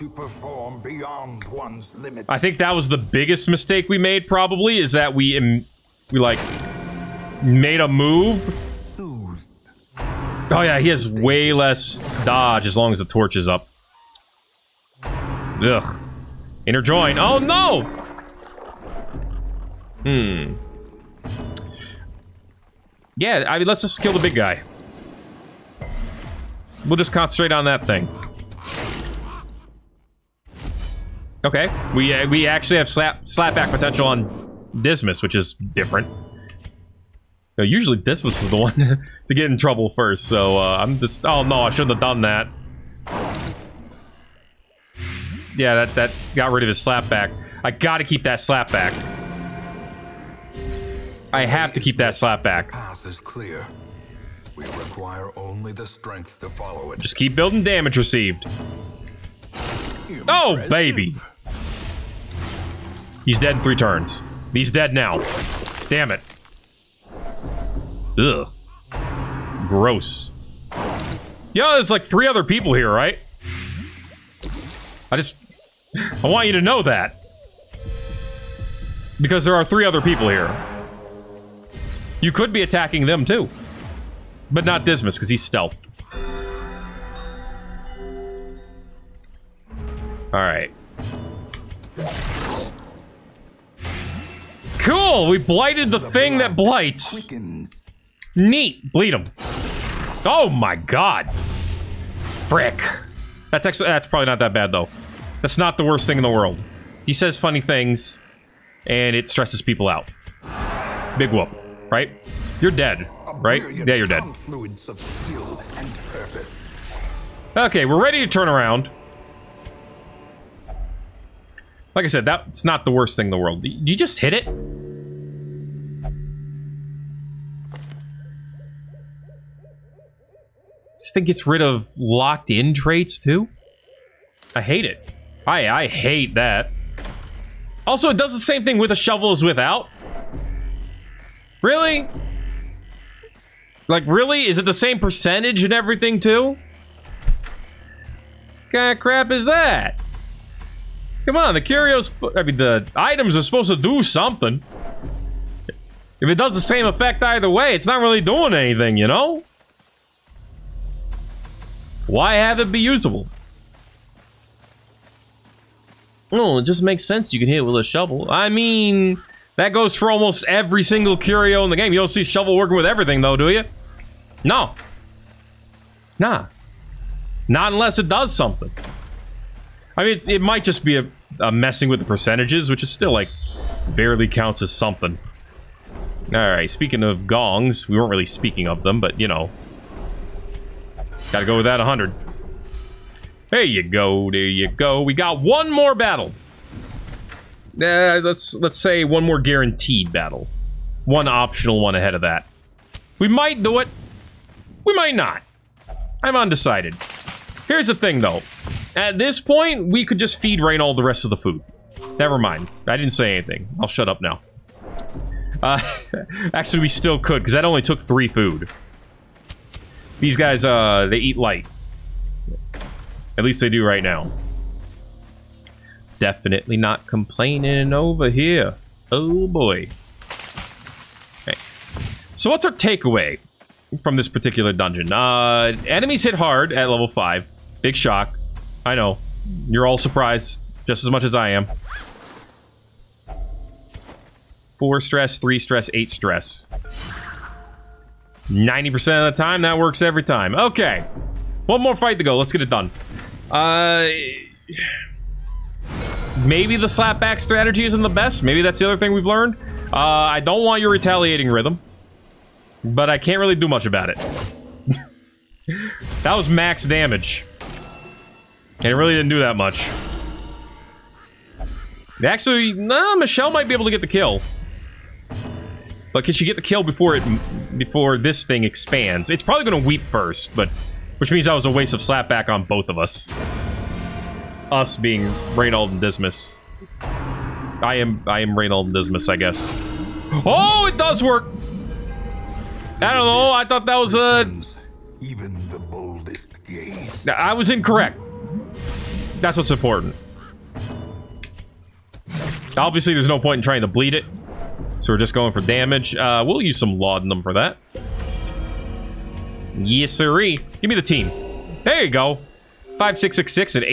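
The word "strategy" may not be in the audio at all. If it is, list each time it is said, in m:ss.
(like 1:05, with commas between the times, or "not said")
4:17.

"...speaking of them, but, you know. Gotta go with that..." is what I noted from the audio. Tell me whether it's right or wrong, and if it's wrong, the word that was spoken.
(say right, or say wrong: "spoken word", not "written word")
right.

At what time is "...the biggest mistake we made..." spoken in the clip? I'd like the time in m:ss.
0:02.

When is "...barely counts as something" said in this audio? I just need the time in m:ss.
3:03.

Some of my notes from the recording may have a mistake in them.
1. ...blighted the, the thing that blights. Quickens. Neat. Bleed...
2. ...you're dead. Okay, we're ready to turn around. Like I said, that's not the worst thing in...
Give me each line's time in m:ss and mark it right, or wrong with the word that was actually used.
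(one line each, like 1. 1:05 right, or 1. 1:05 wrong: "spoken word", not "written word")
1. 1:35 right
2. 1:53 right.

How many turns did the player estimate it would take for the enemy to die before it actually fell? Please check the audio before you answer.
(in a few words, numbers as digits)
3.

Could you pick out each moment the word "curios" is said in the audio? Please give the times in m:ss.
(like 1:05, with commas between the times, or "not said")
2:31, 2:51.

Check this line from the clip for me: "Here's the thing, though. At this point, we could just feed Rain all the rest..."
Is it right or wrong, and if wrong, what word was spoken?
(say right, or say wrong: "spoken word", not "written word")
right.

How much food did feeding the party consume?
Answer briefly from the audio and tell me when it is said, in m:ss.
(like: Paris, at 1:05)
3, at 3:37.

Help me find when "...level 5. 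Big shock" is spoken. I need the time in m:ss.
3:56.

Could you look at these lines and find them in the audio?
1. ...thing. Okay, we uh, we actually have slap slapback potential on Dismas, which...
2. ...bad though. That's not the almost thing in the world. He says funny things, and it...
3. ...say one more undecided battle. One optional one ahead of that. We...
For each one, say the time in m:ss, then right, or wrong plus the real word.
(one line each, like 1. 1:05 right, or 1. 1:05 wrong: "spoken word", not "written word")
1. 0:27 right
2. 1:44 wrong: "worst", not "almost"
3. 3:18 wrong: "guaranteed", not "undecided".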